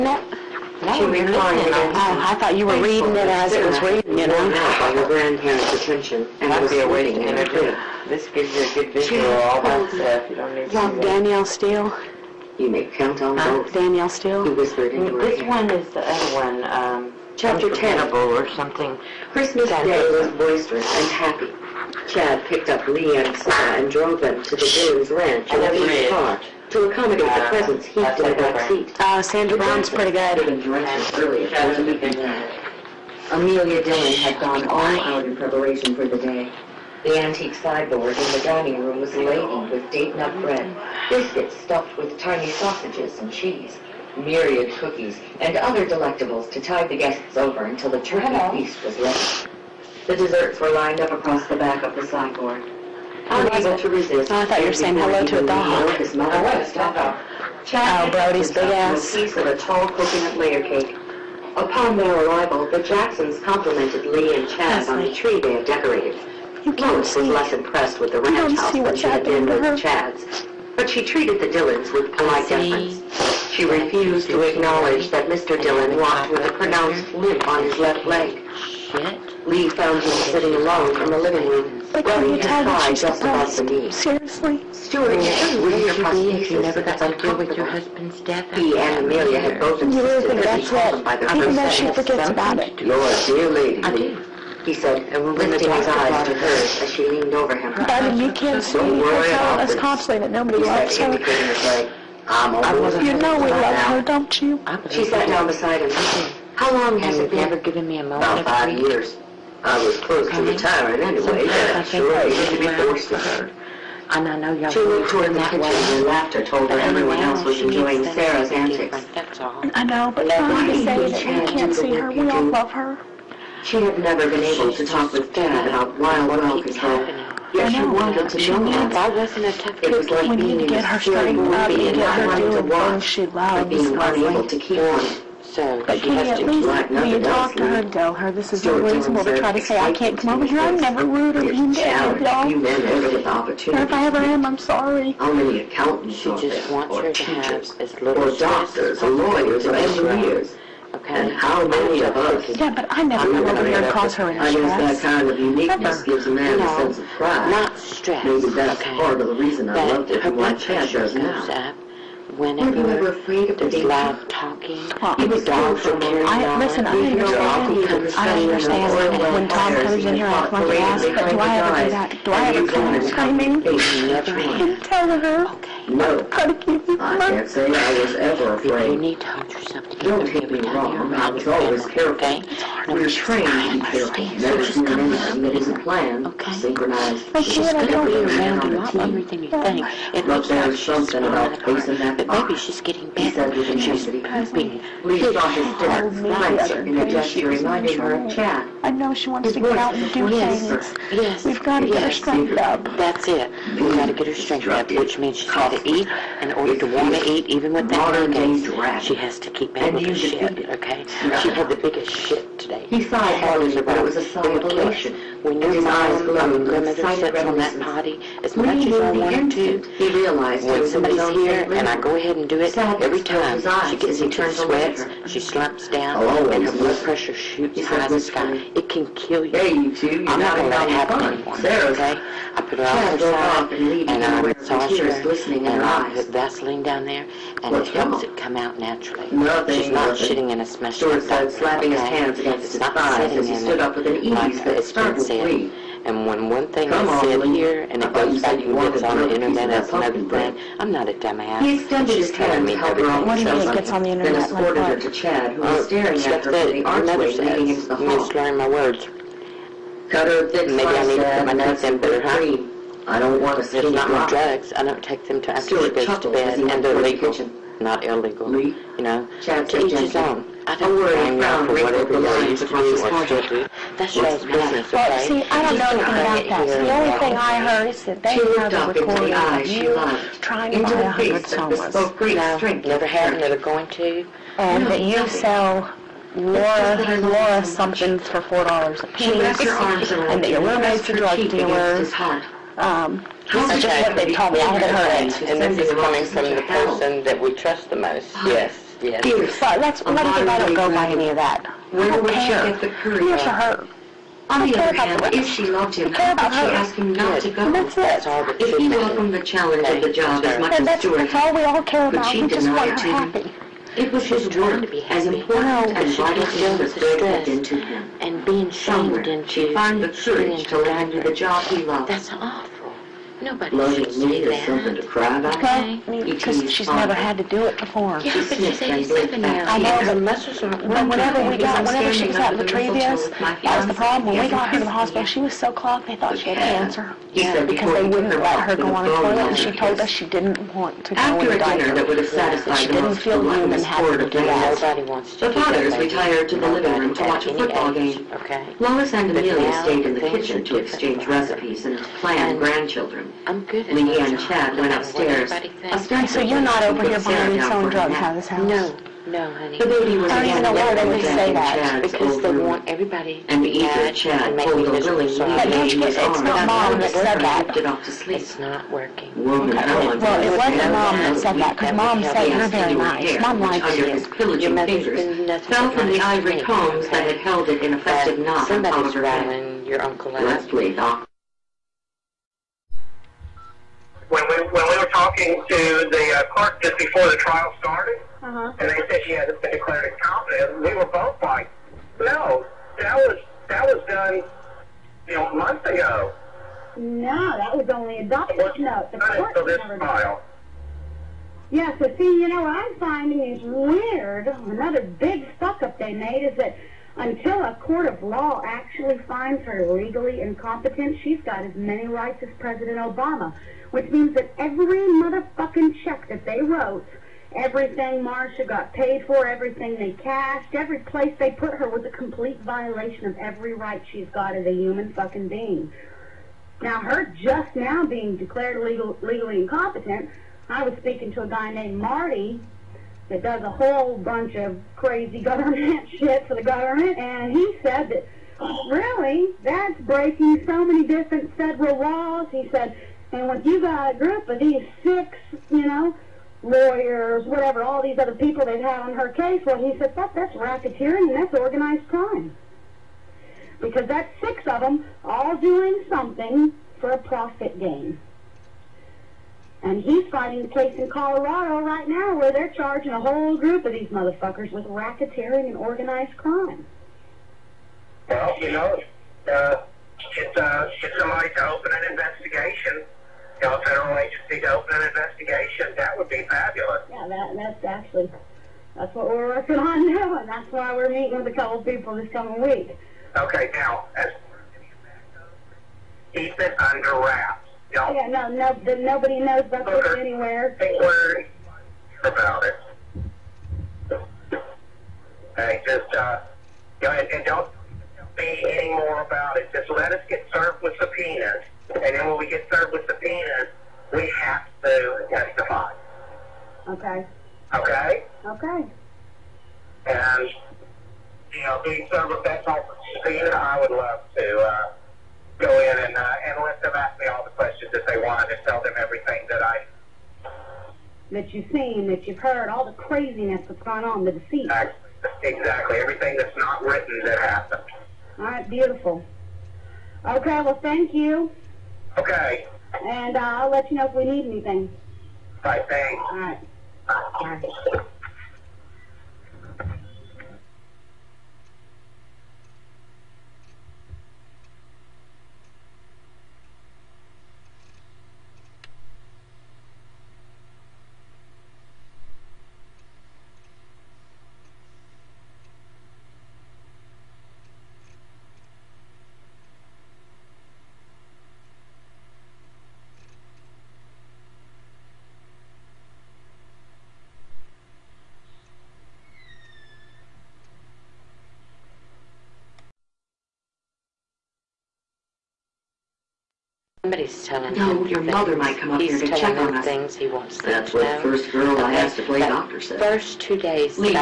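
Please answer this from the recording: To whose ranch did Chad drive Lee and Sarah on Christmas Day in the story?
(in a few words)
Boone's Ranch.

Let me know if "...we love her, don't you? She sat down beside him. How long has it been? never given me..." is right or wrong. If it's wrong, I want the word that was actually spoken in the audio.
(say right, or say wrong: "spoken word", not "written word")
right.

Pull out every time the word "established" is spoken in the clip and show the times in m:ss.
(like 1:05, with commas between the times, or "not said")
not said.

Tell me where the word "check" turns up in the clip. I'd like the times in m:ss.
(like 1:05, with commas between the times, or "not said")
6:56, 9:39.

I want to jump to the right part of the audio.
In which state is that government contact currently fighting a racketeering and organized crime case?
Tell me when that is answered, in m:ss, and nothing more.
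7:41.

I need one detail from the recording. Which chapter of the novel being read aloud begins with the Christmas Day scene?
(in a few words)
Chapter 10.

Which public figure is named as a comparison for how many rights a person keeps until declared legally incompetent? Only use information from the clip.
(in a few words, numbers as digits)
President Obama.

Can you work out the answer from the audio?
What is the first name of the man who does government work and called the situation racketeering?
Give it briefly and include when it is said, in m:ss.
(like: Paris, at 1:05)
Marty, at 7:11.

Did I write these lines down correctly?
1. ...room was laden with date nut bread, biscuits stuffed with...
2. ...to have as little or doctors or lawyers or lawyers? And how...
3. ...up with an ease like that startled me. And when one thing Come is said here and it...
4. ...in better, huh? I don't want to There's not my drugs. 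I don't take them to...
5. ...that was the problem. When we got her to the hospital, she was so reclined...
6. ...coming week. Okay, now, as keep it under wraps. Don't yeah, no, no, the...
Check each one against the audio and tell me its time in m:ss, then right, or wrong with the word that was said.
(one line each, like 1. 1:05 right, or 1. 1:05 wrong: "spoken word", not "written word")
1. 0:38 right
2. 2:27 wrong: "engineers", not "lawyers"
3. 4:03 right
4. 4:21 right
5. 5:33 wrong: "clogged", not "reclined"
6. 8:02 right.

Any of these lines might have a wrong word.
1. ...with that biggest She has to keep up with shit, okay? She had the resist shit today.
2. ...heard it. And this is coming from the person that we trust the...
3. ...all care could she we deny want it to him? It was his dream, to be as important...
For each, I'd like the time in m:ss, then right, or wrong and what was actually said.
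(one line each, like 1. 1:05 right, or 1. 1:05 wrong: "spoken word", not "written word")
1. 3:27 wrong: "biggest", not "resist"
2. 4:54 right
3. 5:11 right.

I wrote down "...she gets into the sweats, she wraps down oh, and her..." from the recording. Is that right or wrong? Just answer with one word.
wrong.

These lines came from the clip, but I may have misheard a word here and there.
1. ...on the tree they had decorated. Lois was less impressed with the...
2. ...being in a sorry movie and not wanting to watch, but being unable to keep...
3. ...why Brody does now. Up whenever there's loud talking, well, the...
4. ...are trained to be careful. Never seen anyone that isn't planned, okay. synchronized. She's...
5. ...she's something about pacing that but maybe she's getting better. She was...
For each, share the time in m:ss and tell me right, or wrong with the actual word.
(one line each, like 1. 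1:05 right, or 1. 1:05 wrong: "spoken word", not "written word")
1. 1:04 right
2. 2:10 wrong: "scary", not "sorry"
3. 2:40 wrong: "Chad", not "Brody"
4. 3:03 right
5. 3:10 right.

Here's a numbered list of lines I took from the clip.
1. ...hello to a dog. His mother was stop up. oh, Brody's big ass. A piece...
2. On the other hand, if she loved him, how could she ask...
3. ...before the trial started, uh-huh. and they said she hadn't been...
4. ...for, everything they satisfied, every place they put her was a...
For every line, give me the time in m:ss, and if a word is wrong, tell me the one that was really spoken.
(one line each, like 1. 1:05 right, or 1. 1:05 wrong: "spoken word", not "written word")
1. 0:54 right
2. 5:04 right
3. 6:26 right
4. 6:59 wrong: "cashed", not "satisfied".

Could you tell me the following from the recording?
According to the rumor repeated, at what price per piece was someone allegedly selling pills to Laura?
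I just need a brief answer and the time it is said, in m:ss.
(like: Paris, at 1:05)
$4, at 4:48.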